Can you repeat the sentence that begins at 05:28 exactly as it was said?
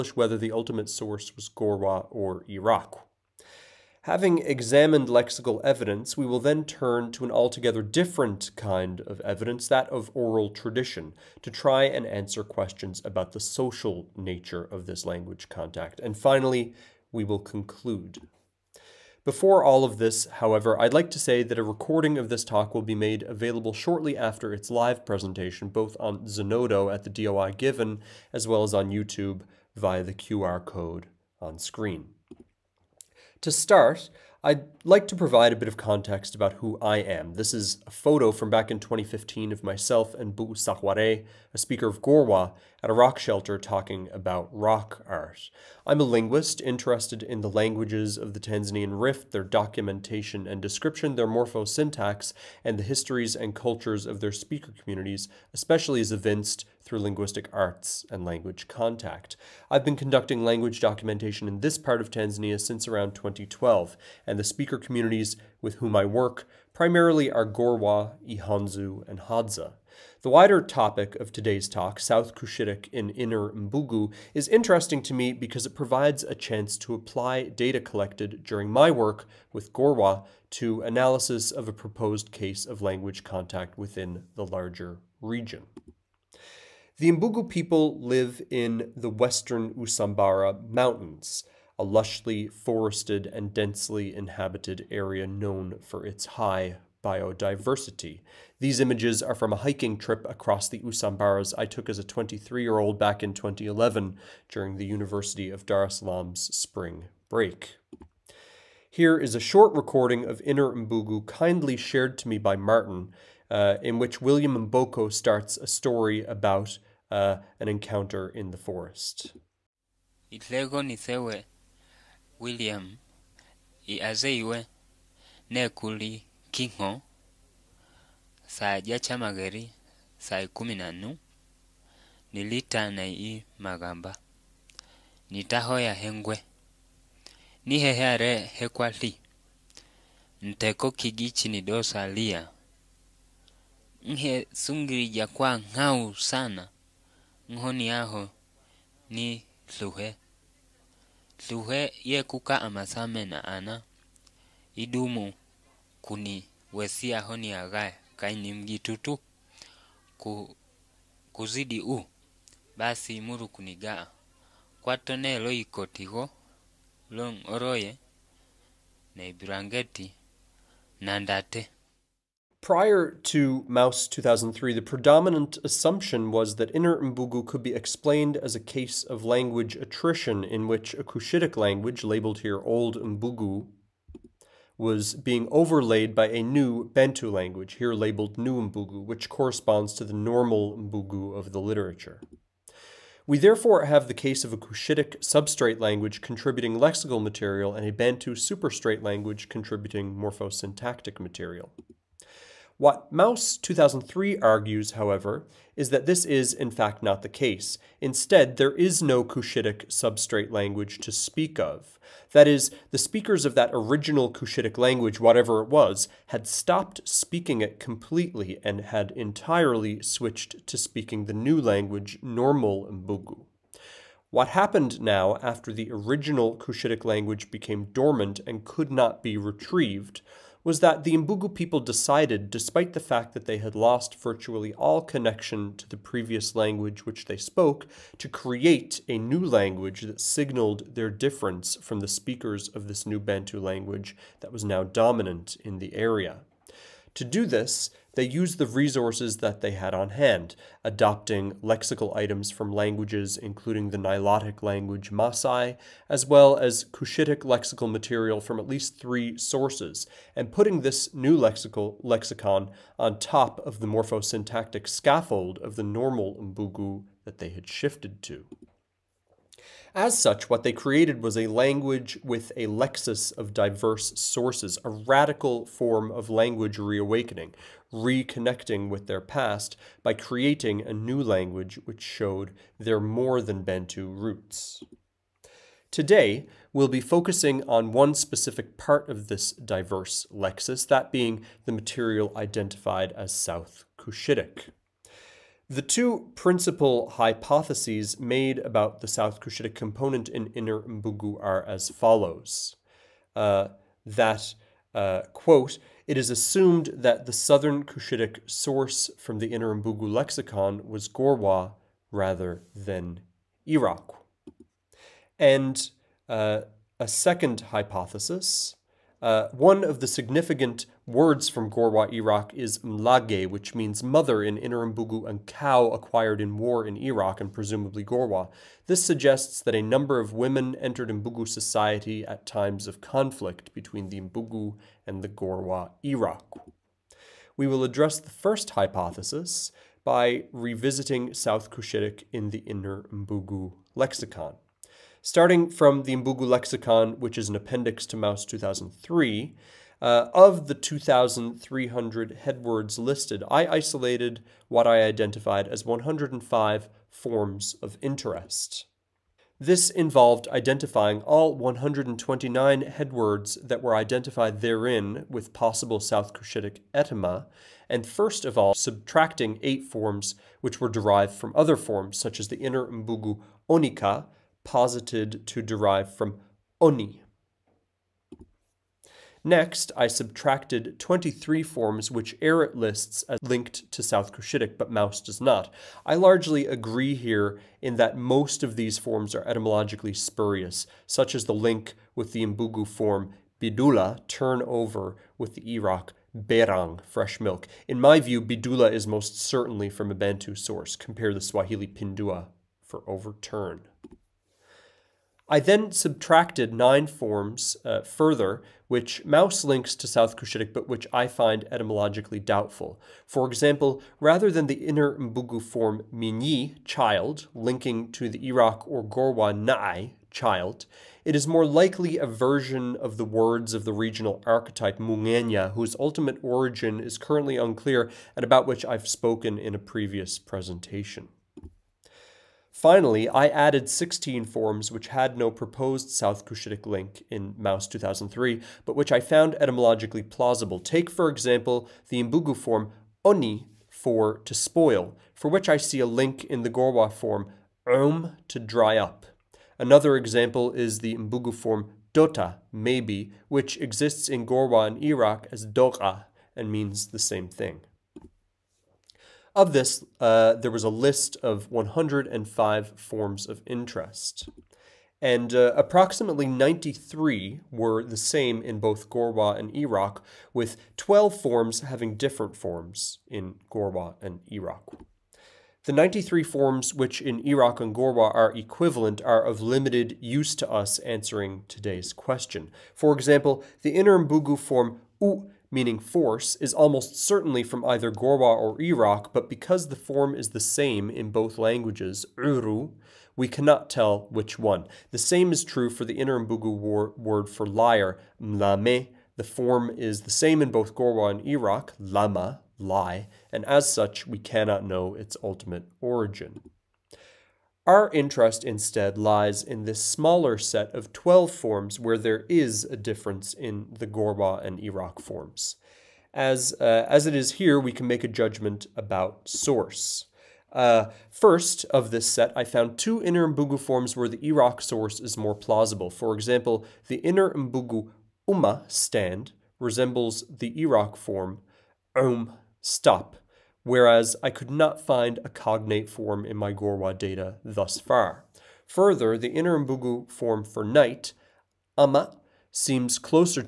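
This suggests that a number of women entered Mbugu society at times of conflict between the Mbugu and the Gorwa Iraqw.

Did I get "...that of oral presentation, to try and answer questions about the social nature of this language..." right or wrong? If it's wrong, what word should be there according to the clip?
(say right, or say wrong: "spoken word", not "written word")
wrong: "tradition", not "presentation".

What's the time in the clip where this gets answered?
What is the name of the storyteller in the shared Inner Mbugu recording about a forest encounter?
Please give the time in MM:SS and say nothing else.
01:54.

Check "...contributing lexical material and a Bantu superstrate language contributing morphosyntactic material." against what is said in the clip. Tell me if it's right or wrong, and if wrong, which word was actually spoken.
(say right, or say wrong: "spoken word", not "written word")
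right.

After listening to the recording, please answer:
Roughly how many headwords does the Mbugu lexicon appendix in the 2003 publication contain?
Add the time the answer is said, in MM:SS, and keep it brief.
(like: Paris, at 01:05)
2,300, at 05:50.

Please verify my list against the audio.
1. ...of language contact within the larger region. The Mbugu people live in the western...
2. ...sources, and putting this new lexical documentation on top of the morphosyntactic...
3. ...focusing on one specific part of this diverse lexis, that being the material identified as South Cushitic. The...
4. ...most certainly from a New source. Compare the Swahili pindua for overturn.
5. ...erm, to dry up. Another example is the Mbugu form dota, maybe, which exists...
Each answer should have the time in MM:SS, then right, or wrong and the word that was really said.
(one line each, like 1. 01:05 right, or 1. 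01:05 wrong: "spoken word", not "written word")
1. 01:22 right
2. 04:19 wrong: "lexicon", not "documentation"
3. 04:47 right
4. 06:39 wrong: "Bantu", not "New"
5. 07:28 right.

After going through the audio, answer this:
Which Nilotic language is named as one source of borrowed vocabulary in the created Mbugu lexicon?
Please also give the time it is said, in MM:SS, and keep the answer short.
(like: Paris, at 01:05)
Masai, at 04:15.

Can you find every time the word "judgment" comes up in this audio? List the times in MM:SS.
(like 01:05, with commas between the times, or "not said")
08:38.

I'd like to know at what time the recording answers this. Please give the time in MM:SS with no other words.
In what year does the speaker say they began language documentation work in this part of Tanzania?
01:03.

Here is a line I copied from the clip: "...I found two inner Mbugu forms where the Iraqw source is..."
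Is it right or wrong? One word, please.
right.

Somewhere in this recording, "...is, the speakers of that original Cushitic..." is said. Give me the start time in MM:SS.
03:32.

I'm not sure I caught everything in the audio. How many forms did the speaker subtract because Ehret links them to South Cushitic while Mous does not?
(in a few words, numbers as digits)
23.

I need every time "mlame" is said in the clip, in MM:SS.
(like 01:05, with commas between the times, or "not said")
08:18.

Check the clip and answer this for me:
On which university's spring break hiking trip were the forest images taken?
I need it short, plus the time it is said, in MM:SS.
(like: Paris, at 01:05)
University of Dar es Salaam, at 01:44.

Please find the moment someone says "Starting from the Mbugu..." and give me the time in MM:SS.
05:45.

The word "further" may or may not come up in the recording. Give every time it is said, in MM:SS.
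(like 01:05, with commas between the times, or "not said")
06:48, 08:58.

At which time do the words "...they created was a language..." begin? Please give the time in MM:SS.
04:30.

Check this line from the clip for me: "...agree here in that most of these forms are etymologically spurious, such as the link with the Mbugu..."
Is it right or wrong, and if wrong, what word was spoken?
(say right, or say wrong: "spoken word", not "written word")
right.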